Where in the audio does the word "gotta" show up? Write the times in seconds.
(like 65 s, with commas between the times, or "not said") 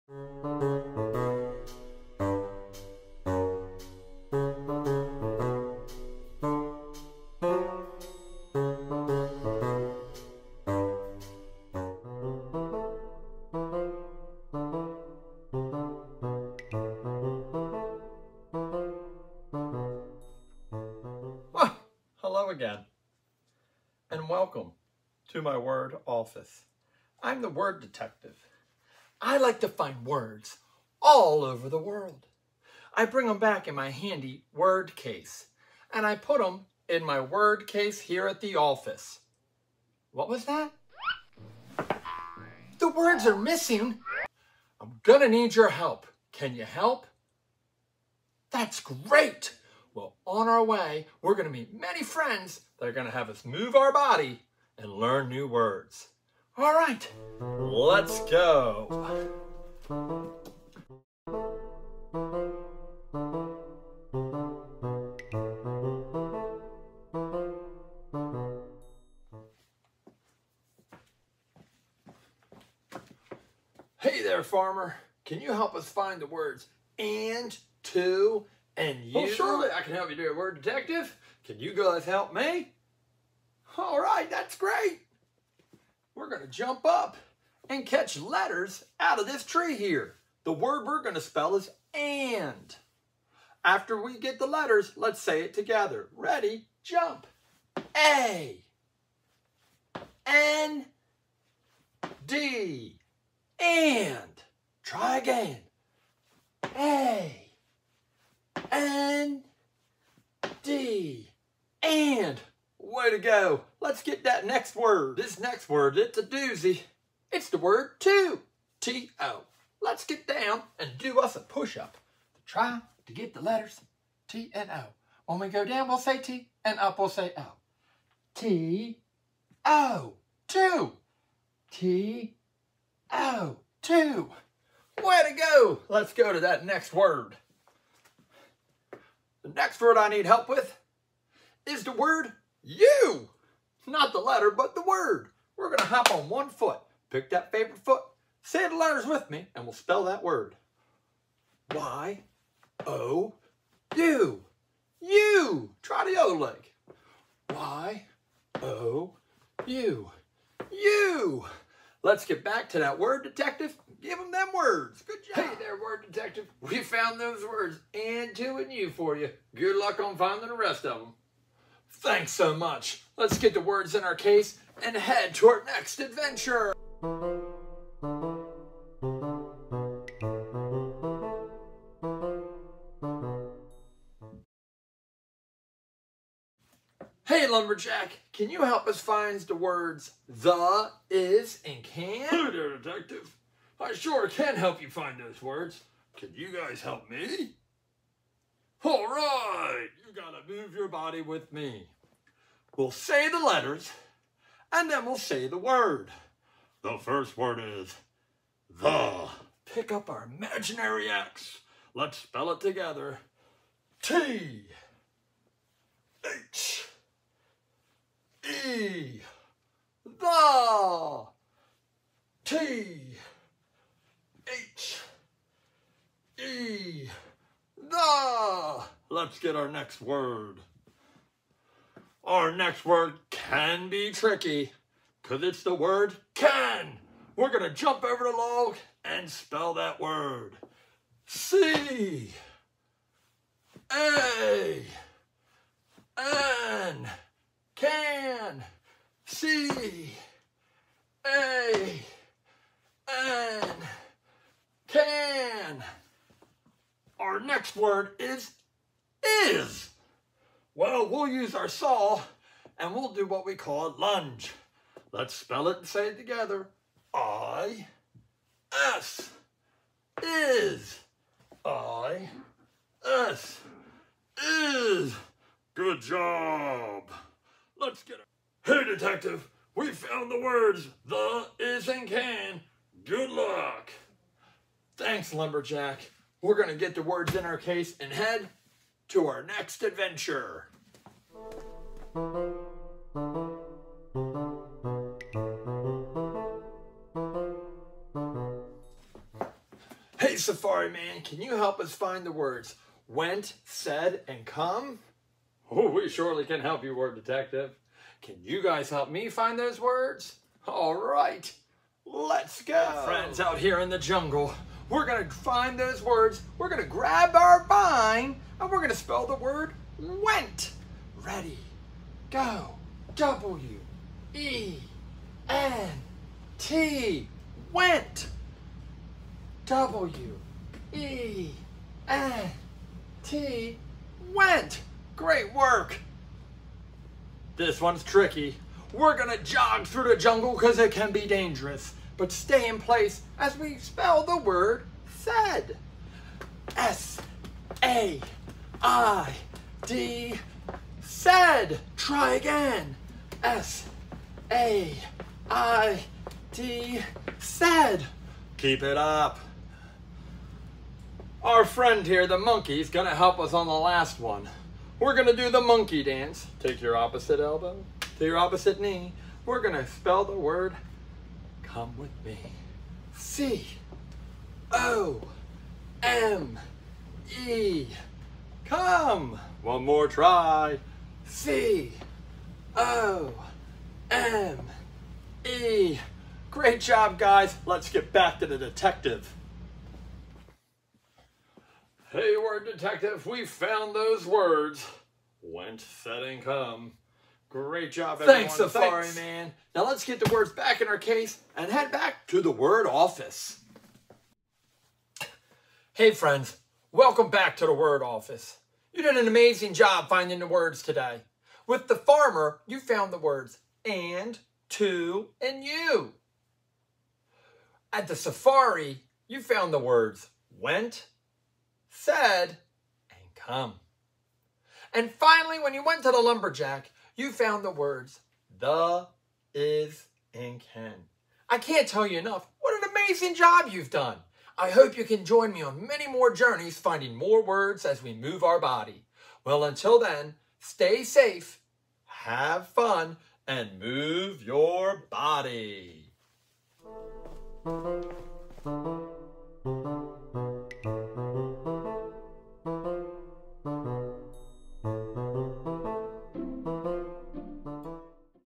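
200 s.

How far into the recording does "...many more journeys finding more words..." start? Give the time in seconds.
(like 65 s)
435 s.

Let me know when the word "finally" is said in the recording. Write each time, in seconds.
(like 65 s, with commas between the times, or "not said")
425 s.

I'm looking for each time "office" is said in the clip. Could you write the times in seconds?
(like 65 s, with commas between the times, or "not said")
26 s, 38 s, 402 s, 408 s.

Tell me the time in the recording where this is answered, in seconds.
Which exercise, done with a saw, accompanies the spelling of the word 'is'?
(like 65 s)
263 s.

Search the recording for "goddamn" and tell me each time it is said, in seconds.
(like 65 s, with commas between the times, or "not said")
not said.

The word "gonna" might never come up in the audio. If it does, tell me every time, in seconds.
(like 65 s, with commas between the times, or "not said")
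45 s, 339 s.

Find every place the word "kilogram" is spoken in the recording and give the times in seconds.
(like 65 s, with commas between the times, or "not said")
not said.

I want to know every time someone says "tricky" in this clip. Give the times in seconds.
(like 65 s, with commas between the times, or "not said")
234 s, 338 s.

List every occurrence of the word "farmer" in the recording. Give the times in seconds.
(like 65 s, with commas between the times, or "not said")
74 s, 411 s.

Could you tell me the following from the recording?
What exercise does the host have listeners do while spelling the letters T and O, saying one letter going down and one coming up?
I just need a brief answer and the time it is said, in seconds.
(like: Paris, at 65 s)
Push-up, at 121 s.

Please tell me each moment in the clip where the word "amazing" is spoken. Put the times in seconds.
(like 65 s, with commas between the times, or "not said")
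409 s, 432 s.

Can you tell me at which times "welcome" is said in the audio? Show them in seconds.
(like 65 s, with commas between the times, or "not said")
24 s, 406 s.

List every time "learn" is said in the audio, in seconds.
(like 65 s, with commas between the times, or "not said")
54 s.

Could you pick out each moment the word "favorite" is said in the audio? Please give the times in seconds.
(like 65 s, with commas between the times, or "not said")
147 s.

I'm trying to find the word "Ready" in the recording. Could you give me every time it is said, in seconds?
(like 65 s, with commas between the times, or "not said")
96 s, 321 s.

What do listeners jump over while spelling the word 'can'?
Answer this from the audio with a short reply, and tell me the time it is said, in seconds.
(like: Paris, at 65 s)
The log, at 238 s.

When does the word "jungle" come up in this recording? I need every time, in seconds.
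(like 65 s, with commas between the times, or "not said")
313 s, 340 s.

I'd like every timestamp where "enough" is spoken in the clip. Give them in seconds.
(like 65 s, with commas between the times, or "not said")
432 s.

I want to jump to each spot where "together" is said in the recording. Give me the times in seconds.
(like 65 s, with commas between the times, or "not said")
95 s, 212 s, 266 s.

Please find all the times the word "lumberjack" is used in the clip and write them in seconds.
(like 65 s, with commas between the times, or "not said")
187 s, 285 s, 426 s.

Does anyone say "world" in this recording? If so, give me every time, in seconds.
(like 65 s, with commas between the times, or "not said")
31 s.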